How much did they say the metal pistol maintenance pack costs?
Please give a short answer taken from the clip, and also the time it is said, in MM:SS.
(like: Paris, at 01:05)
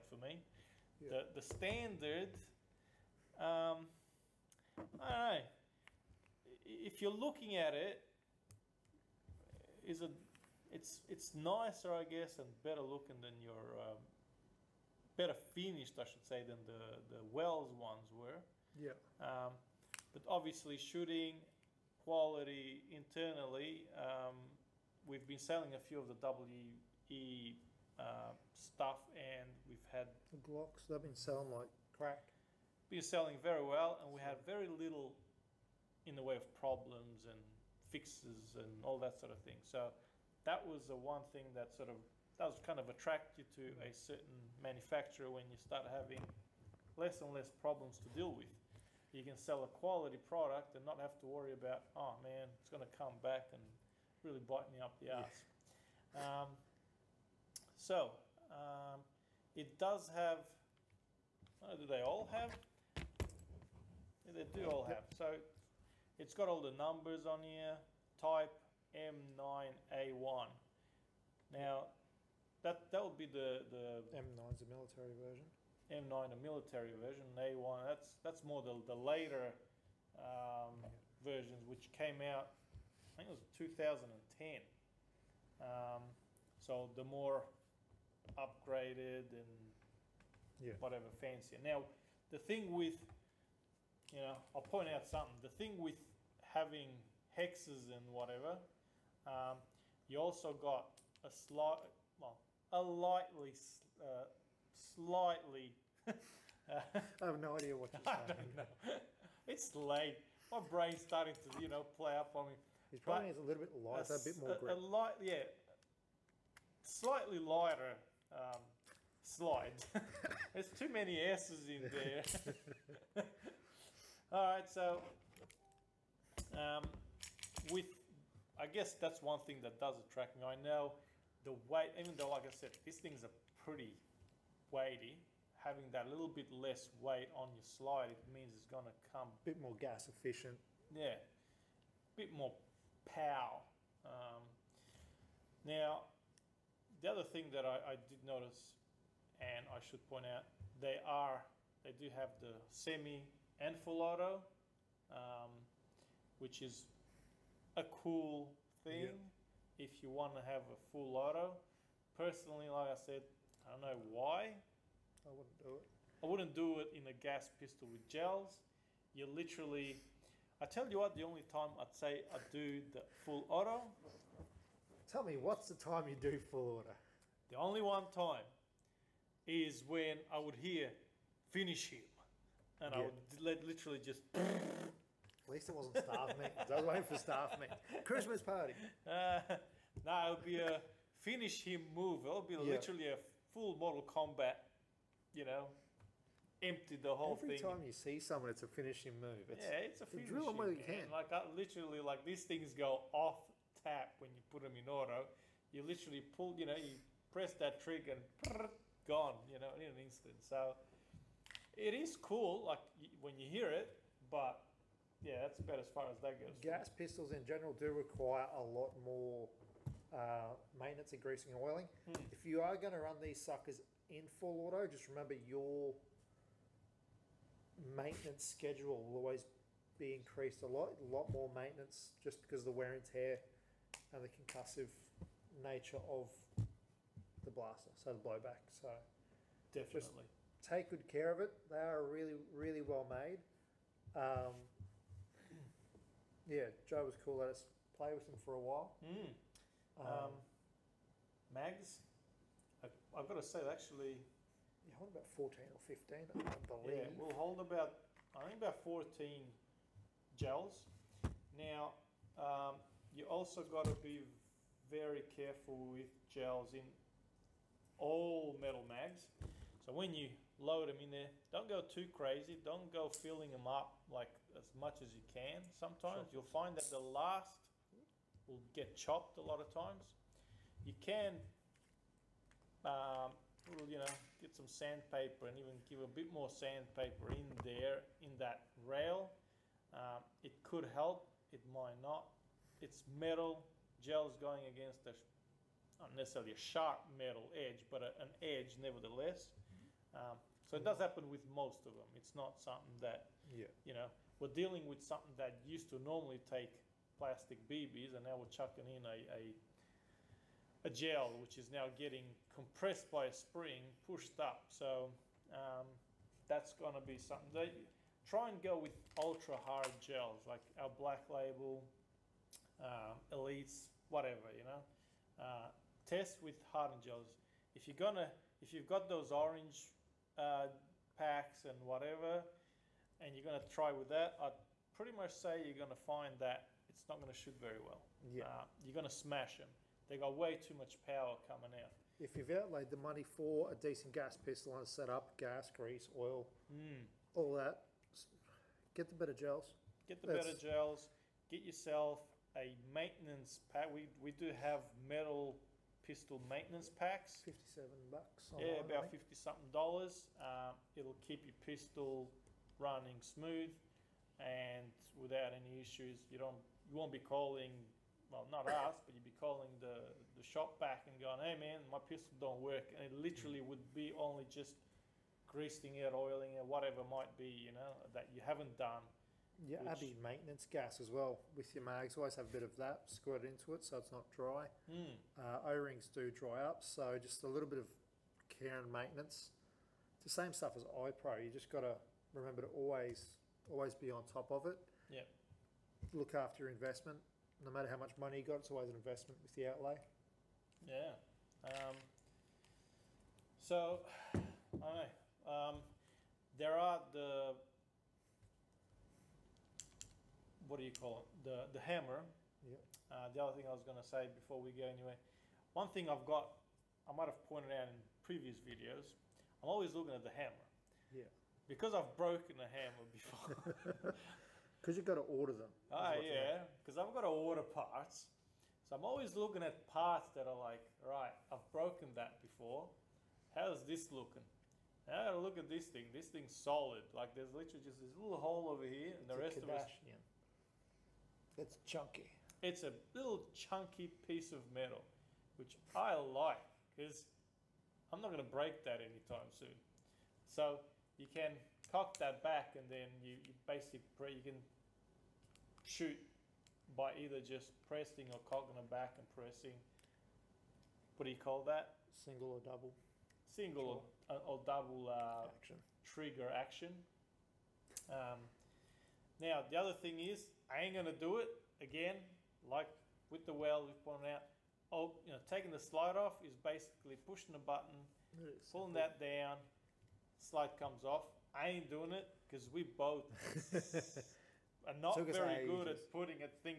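$57, at 05:57.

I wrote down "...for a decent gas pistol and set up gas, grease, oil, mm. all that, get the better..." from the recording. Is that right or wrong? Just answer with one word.
right.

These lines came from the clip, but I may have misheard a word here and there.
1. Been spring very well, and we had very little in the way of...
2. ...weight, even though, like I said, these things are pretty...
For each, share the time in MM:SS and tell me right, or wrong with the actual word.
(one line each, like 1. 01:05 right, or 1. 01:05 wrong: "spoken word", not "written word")
1. 00:32 wrong: "selling", not "spring"
2. 02:11 right.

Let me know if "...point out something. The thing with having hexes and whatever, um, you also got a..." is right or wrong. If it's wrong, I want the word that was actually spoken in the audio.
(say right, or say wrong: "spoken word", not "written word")
right.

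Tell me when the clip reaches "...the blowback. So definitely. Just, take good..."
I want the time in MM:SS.
03:58.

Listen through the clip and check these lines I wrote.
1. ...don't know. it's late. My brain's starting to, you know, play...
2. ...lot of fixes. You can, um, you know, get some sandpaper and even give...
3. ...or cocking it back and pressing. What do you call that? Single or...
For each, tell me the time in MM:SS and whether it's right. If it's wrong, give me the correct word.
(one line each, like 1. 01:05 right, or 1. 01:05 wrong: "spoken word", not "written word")
1. 01:48 right
2. 04:39 wrong: "times", not "fixes"
3. 07:38 right.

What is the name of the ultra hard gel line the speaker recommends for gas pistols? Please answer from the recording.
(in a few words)
Black Label.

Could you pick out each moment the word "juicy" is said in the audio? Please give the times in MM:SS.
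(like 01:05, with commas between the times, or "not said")
not said.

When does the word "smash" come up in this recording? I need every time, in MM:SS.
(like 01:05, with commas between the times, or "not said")
05:39.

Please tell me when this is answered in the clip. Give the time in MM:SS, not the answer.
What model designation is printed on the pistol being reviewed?
01:08.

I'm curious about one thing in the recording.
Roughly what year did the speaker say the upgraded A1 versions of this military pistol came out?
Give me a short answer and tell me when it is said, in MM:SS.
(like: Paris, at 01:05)
2010, at 01:23.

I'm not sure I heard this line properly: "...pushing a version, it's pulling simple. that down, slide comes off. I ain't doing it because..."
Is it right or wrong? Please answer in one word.
wrong.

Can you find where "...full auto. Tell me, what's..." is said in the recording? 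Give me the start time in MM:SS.
02:53.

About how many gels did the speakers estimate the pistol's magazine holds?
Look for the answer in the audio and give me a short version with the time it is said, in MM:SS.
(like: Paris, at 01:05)
14, at 04:18.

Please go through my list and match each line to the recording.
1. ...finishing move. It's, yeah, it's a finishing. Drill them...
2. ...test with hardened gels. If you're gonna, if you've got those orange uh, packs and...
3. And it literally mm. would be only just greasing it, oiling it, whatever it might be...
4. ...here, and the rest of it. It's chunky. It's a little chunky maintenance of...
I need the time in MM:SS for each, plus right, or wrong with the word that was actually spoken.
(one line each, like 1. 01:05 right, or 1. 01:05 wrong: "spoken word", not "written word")
1. 03:18 right
2. 05:26 right
3. 06:12 right
4. 07:18 wrong: "piece", not "maintenance".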